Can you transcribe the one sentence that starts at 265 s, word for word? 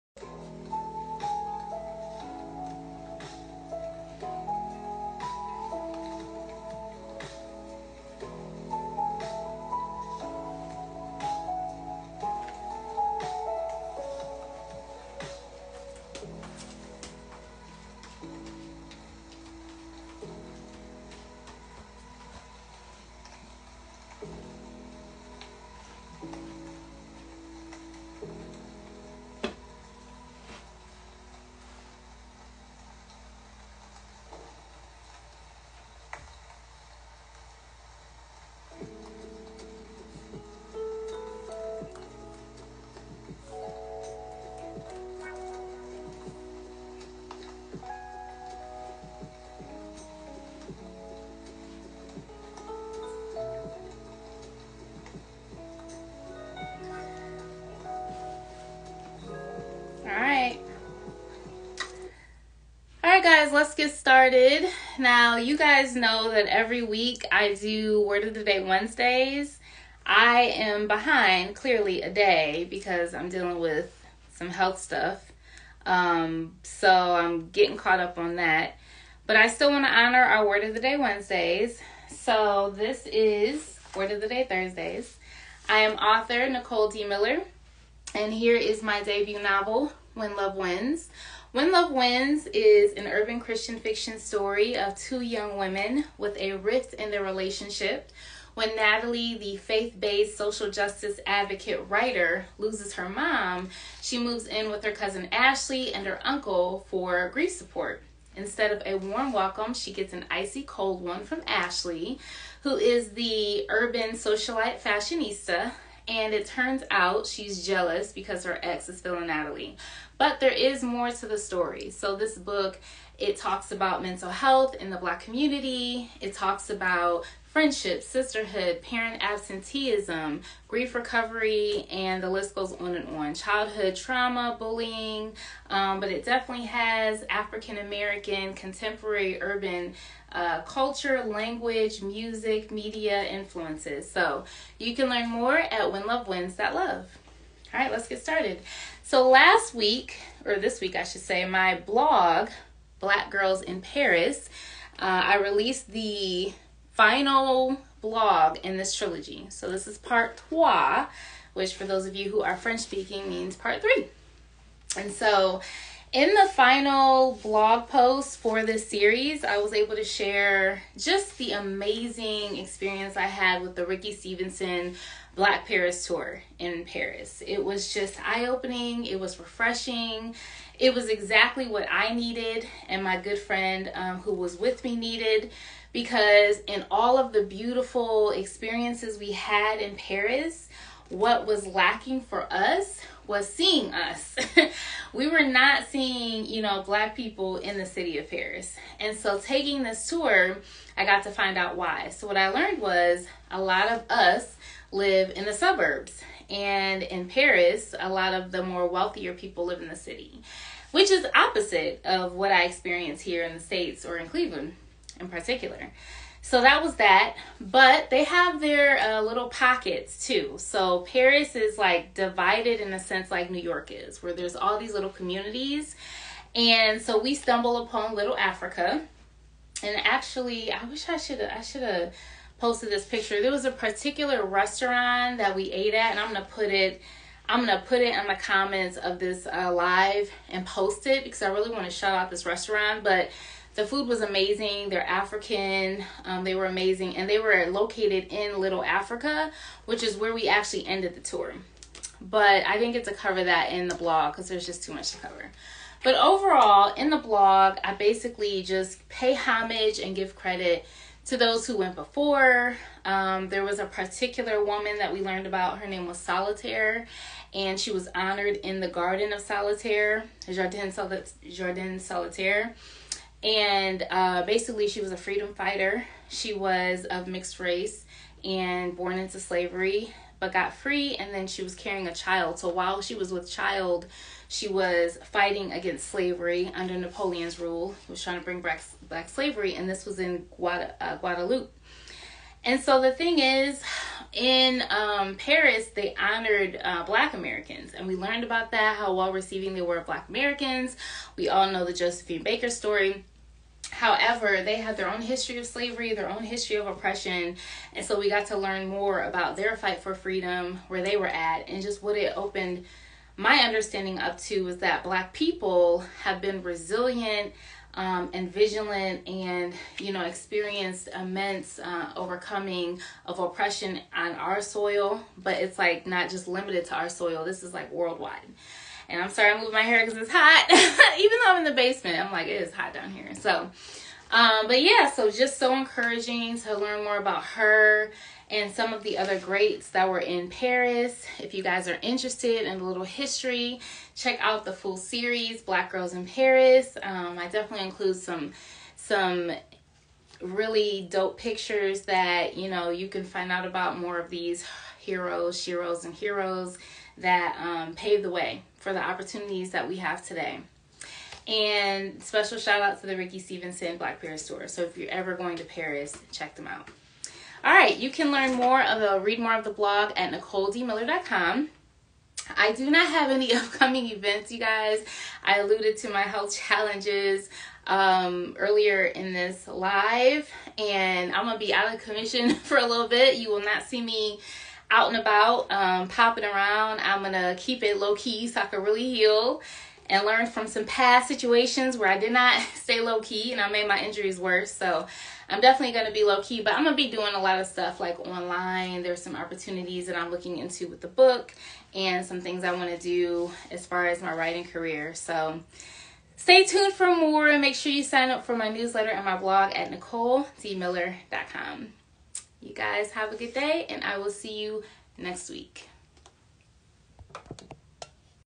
Her name was Solitaire, and she was honored in the Garden of Solitaire, Jardin, Jardin Solitaire.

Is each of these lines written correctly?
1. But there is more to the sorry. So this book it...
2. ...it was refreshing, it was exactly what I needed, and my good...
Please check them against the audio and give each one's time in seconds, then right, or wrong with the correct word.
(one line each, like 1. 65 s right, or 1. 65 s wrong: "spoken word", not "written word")
1. 120 s wrong: "story", not "sorry"
2. 179 s right.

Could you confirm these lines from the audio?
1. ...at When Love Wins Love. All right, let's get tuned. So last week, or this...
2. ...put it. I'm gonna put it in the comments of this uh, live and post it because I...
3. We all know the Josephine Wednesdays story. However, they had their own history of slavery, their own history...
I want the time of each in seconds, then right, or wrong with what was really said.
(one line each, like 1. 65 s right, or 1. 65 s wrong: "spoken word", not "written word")
1. 145 s wrong: "started", not "tuned"
2. 236 s right
3. 301 s wrong: "Baker", not "Wednesdays".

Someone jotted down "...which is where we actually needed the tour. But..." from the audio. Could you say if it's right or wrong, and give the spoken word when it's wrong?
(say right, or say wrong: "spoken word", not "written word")
wrong: "ended", not "needed".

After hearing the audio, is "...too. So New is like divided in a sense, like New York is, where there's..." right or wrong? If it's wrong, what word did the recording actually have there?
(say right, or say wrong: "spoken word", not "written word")
wrong: "Paris", not "New".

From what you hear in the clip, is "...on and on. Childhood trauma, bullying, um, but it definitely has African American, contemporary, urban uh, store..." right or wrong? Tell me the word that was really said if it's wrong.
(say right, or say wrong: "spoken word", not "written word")
wrong: "culture", not "store".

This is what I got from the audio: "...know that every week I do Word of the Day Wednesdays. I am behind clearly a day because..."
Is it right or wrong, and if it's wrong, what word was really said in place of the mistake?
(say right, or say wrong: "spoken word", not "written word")
right.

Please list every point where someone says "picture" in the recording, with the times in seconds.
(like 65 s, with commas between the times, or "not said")
233 s, 351 s.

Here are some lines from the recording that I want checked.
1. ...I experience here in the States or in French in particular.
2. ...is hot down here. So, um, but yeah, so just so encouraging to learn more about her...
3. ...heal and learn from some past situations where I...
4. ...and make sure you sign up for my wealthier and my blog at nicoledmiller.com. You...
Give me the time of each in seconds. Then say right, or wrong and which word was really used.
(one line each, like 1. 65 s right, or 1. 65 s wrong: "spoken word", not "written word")
1. 212 s wrong: "Cleveland", not "French"
2. 332 s right
3. 389 s right
4. 407 s wrong: "newsletter", not "wealthier".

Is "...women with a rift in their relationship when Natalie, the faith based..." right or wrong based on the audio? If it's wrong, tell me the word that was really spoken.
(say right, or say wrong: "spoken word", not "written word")
right.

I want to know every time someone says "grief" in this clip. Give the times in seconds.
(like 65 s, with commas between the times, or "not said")
107 s, 130 s.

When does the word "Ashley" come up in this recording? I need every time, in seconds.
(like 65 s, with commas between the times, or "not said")
105 s, 111 s.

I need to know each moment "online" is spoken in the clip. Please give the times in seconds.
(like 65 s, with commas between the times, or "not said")
398 s.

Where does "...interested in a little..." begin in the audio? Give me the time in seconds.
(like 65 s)
342 s.